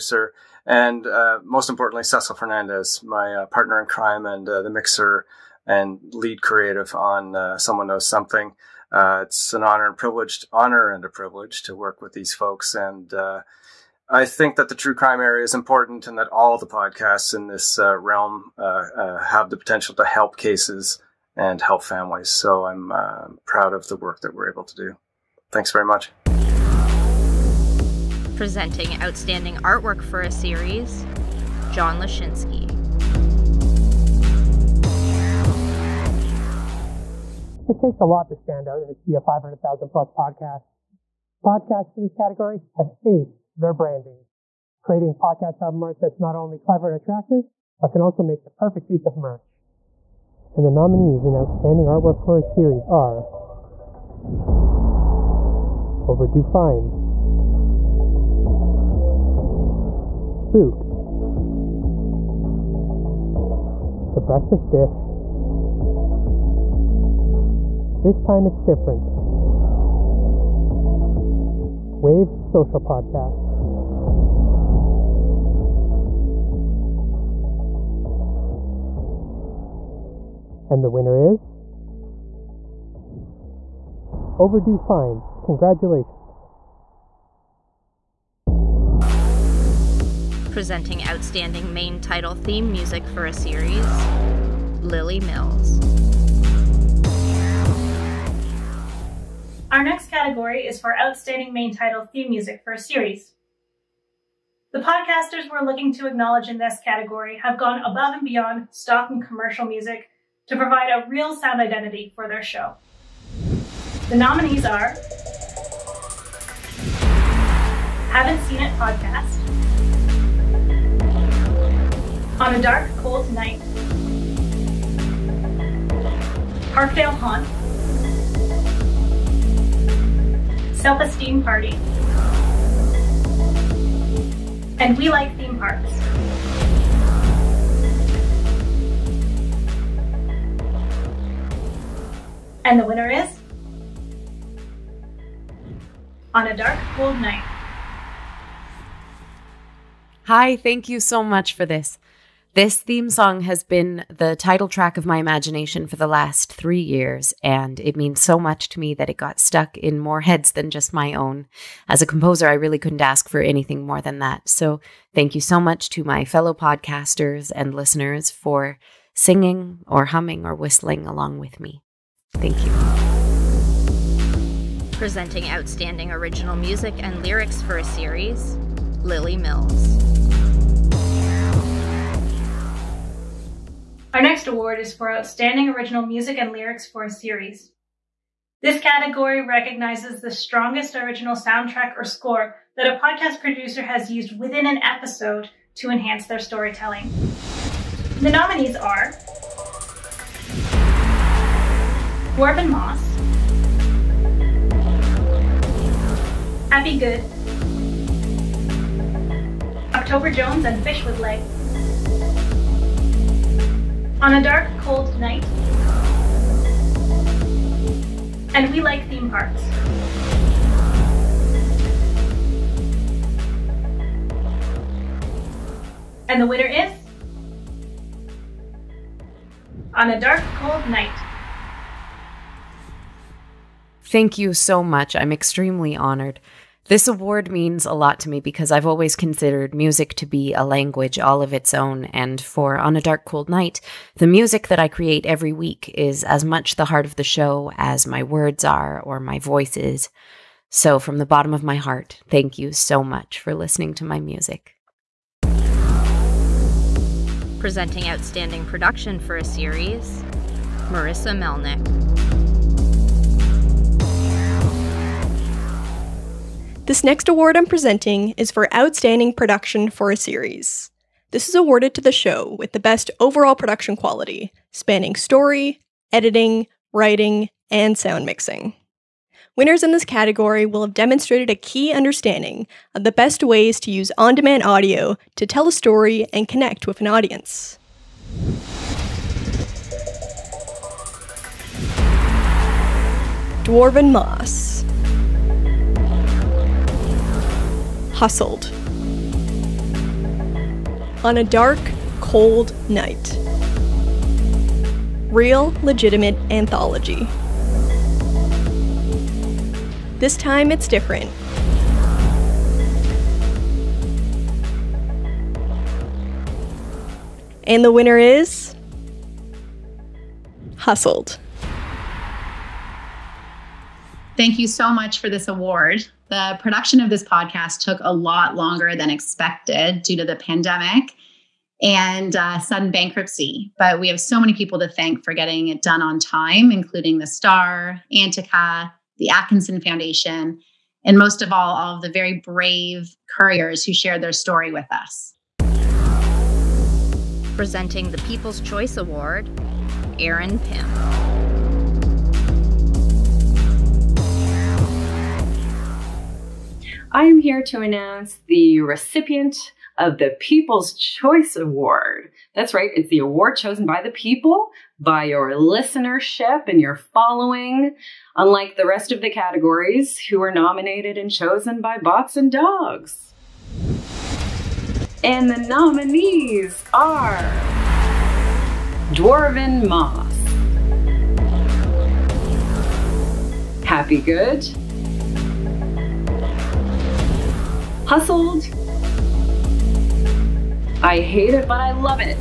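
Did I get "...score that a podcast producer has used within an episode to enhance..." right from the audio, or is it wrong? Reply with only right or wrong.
right.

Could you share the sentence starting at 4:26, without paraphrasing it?
This next award I'm presenting is for Outstanding Production for a Series.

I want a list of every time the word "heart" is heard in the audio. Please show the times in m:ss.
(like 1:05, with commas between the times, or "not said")
4:06, 4:11.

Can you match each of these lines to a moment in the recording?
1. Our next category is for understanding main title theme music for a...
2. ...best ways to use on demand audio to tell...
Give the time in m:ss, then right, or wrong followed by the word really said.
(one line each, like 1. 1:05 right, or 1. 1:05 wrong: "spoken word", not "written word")
1. 1:39 wrong: "outstanding", not "understanding"
2. 4:43 right.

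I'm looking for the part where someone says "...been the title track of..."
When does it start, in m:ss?
2:33.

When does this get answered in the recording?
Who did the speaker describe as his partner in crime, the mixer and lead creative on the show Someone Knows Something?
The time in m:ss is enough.
0:02.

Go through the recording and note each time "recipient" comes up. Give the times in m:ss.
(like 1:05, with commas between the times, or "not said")
5:58.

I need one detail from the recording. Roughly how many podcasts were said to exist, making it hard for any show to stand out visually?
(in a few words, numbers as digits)
500,000 plus.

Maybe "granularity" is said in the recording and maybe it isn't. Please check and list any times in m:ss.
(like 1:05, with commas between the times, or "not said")
not said.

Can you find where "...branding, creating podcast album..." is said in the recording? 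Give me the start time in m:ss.
0:43.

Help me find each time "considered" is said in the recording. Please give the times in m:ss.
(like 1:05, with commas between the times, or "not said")
3:59.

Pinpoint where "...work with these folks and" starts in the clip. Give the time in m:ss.
0:11.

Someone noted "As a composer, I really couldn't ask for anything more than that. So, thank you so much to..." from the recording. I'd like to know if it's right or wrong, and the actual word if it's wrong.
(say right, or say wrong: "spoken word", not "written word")
right.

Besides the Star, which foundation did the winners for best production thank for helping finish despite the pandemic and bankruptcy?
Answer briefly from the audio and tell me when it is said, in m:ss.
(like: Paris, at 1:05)
Atkinson Foundation, at 5:39.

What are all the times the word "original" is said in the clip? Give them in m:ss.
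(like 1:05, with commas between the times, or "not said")
2:56, 3:05, 3:10.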